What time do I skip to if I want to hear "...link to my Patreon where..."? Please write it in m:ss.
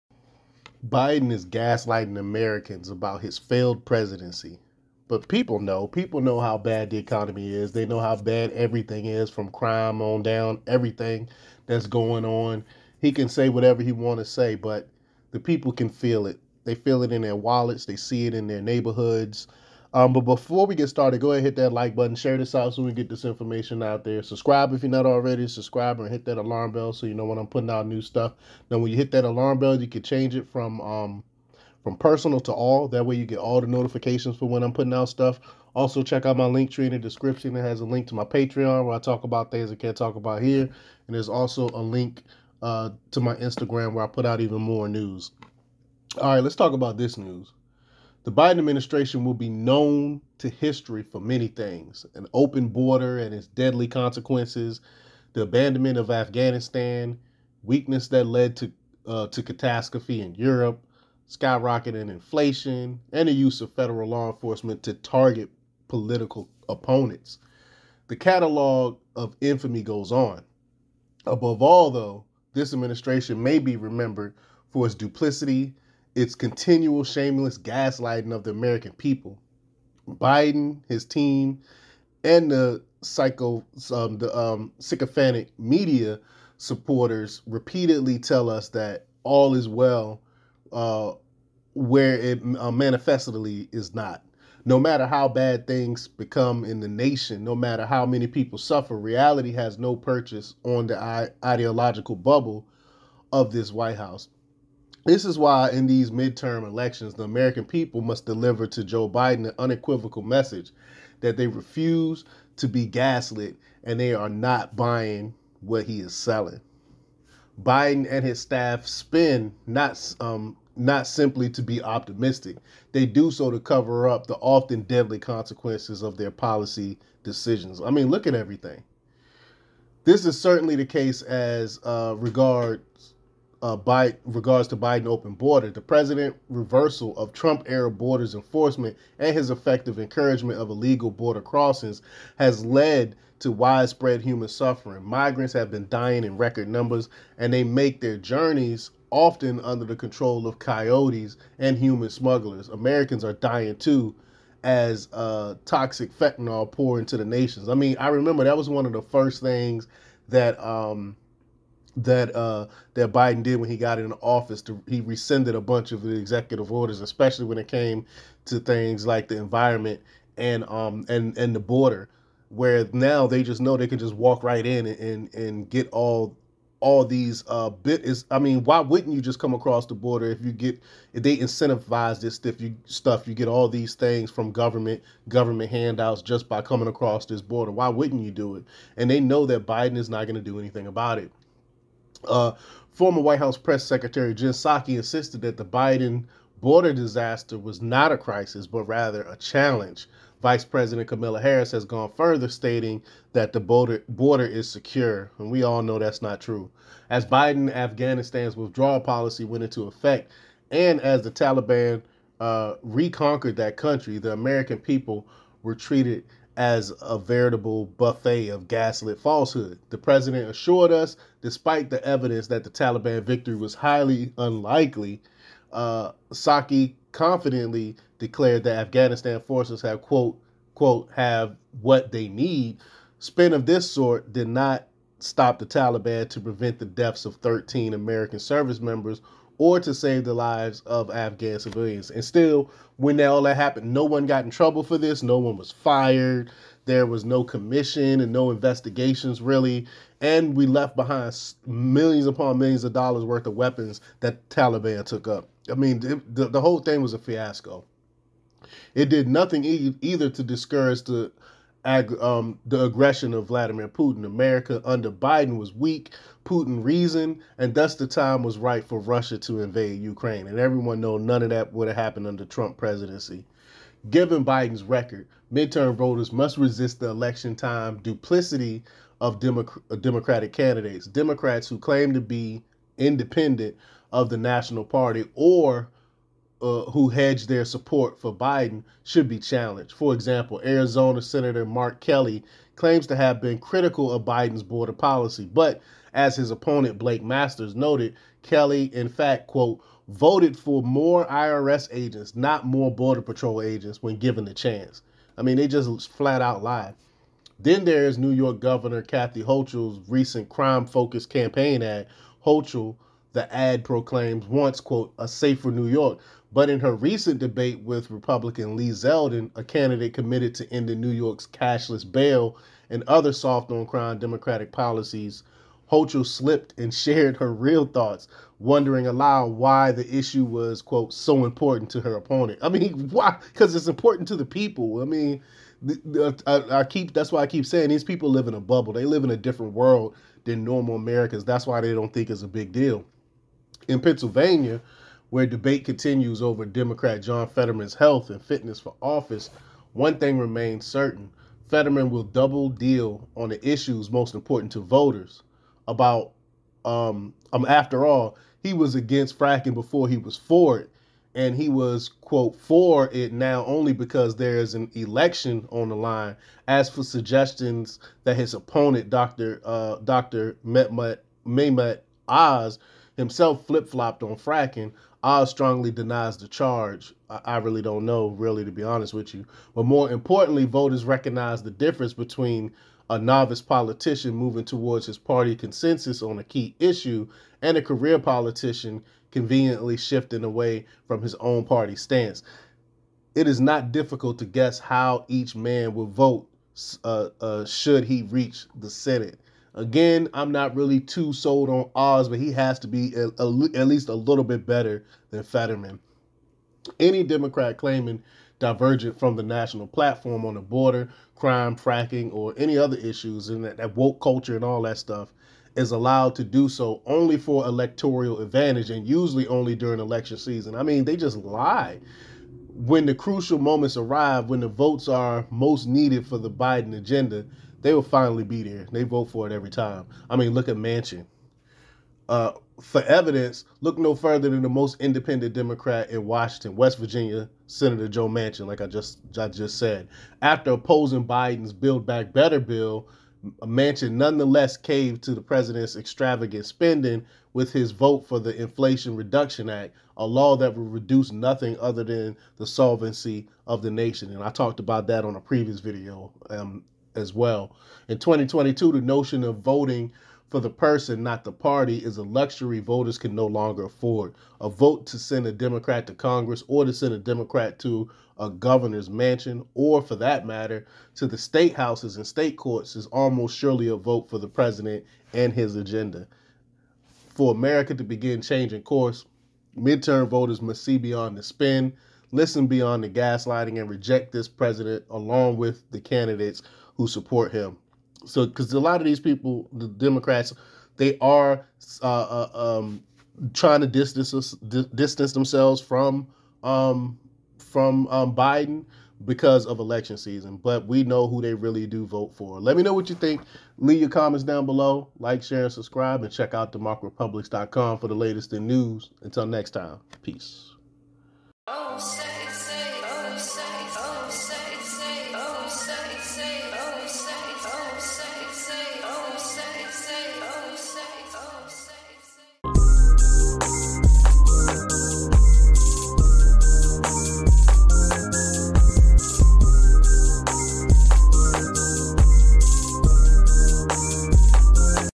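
0:37.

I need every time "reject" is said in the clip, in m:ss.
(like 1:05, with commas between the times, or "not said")
8:03.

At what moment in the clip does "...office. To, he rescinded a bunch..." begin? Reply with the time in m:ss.
2:44.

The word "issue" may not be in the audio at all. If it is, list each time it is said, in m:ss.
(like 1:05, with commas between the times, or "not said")
5:30, 5:53, 6:26, 6:52.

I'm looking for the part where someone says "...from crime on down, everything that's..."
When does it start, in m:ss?
0:09.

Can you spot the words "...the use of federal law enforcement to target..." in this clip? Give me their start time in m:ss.
1:03.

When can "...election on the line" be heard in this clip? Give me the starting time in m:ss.
6:04.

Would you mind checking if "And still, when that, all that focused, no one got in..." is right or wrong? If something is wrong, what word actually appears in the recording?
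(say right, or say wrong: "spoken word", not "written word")
wrong: "happened", not "focused".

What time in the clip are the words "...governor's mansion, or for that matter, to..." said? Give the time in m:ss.
7:48.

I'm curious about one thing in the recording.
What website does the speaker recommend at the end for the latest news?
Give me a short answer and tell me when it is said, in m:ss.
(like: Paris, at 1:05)
democrepublix.com, at 8:26.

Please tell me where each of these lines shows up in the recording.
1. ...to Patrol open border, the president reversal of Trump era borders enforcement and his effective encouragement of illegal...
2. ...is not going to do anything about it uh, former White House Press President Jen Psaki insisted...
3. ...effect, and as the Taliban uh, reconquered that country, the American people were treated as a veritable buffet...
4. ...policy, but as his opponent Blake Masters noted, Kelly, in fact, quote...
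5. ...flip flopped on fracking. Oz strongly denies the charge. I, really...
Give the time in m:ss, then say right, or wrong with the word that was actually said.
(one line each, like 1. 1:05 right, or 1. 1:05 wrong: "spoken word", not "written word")
1. 2:14 wrong: "Biden", not "Patrol"
2. 3:09 wrong: "Secretary", not "President"
3. 3:29 right
4. 4:54 right
5. 6:13 right.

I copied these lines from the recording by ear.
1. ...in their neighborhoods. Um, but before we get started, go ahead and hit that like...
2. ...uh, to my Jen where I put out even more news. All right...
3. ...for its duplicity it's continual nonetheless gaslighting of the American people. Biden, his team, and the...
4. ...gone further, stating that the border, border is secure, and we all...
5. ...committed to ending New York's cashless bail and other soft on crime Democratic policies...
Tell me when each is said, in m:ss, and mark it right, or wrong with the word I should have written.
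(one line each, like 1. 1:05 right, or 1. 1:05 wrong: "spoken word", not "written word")
1. 0:18 right
2. 0:42 wrong: "Instagram", not "Jen"
3. 1:14 wrong: "shameless", not "nonetheless"
4. 3:21 right
5. 5:20 right.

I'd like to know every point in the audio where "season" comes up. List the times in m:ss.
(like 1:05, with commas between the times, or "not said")
7:00, 8:20.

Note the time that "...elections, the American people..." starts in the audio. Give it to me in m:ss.
1:46.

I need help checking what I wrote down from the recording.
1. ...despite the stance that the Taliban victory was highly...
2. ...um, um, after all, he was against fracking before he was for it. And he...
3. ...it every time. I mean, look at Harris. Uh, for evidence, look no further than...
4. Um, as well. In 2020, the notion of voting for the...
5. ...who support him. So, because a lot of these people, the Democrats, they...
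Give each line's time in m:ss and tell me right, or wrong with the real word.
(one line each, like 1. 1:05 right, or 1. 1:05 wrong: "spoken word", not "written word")
1. 3:41 wrong: "evidence", not "stance"
2. 5:56 right
3. 7:09 wrong: "Manchin", not "Harris"
4. 7:36 wrong: "2022", not "2020"
5. 8:06 right.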